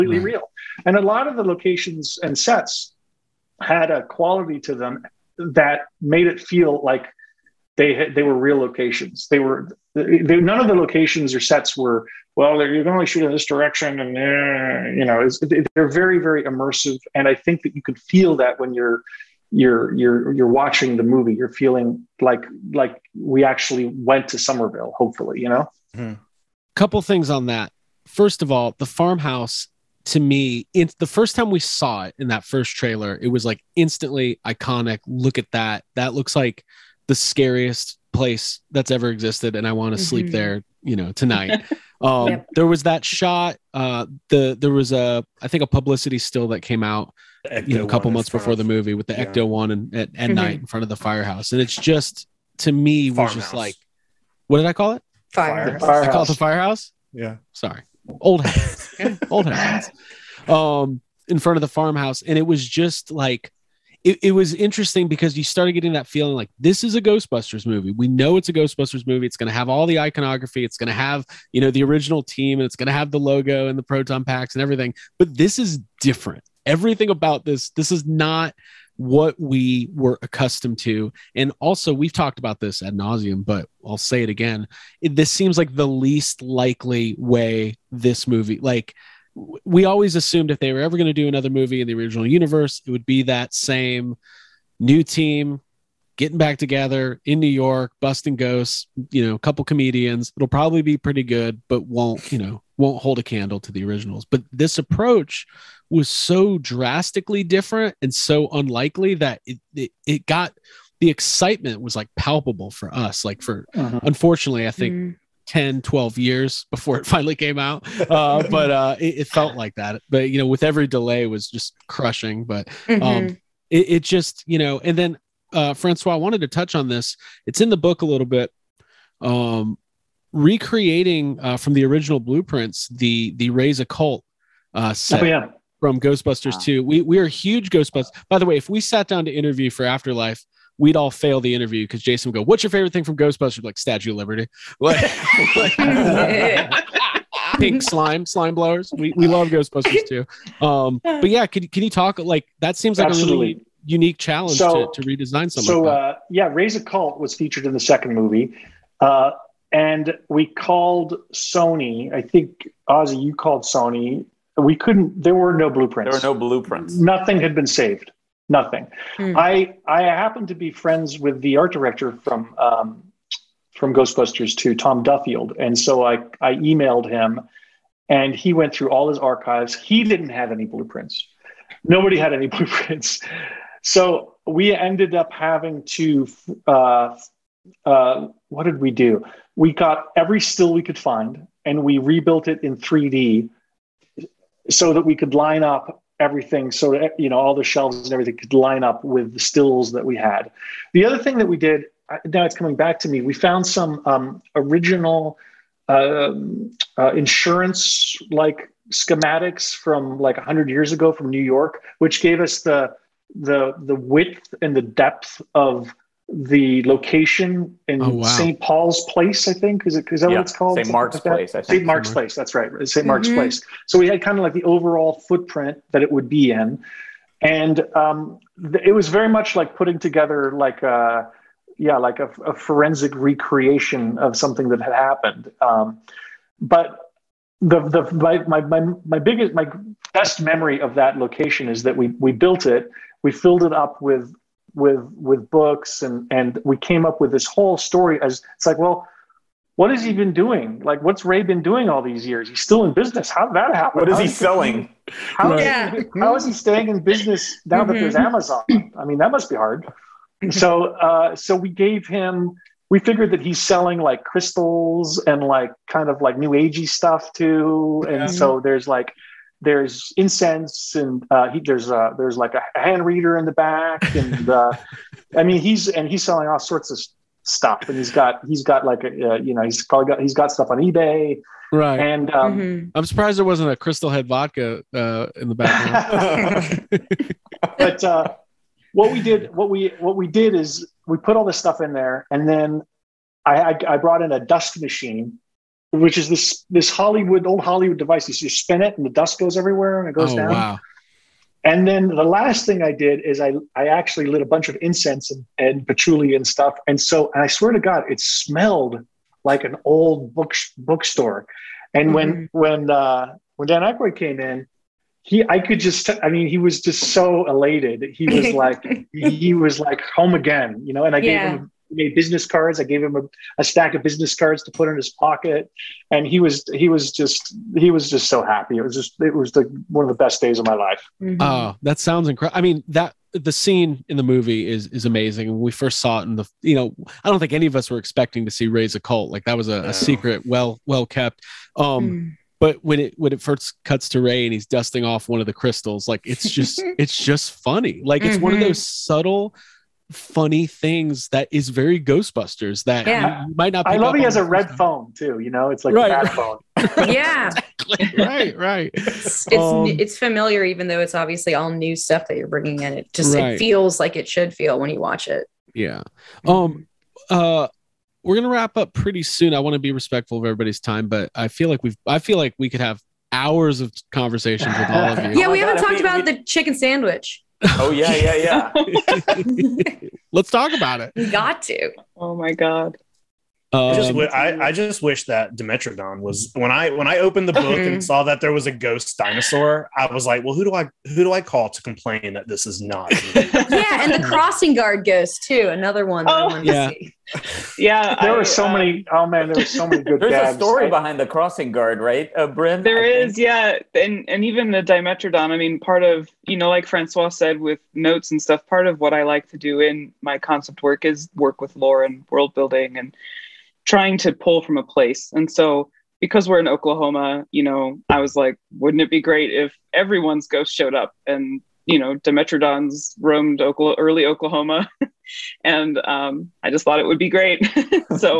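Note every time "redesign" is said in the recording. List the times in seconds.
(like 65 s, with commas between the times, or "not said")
155 s.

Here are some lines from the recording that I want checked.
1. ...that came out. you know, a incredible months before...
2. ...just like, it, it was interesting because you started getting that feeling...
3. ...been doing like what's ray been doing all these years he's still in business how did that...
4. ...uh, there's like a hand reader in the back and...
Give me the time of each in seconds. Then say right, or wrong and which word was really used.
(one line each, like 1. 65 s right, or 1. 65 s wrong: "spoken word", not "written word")
1. 46 s wrong: "couple", not "incredible"
2. 62 s right
3. 250 s right
4. 271 s right.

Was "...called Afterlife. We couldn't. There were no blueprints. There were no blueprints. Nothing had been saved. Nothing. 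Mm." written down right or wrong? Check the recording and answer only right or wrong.
wrong.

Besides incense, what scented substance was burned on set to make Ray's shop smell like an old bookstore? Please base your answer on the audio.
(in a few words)
patchouli.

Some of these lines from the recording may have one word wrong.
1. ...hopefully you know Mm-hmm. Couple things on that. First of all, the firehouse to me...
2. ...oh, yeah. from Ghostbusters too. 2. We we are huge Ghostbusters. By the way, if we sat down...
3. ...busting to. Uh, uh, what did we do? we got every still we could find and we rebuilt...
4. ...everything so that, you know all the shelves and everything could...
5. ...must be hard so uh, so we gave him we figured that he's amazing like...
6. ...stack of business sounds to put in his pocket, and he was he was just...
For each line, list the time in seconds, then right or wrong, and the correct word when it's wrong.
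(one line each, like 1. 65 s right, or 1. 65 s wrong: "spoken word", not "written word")
1. 24 s wrong: "farmhouse", not "firehouse"
2. 135 s right
3. 185 s wrong: "having", not "busting"
4. 196 s right
5. 259 s wrong: "selling", not "amazing"
6. 323 s wrong: "cards", not "sounds".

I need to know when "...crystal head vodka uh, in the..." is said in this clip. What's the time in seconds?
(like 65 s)
283 s.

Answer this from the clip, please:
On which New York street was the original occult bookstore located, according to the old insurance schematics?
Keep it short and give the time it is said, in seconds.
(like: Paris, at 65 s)
St. Mark's Place, at 221 s.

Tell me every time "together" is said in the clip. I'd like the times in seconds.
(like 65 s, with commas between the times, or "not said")
96 s, 229 s.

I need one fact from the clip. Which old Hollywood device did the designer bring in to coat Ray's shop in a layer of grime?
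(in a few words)
dust machine.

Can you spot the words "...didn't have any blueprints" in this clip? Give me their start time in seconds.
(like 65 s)
180 s.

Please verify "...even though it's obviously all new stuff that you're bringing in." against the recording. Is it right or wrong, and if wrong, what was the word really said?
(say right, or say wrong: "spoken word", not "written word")
right.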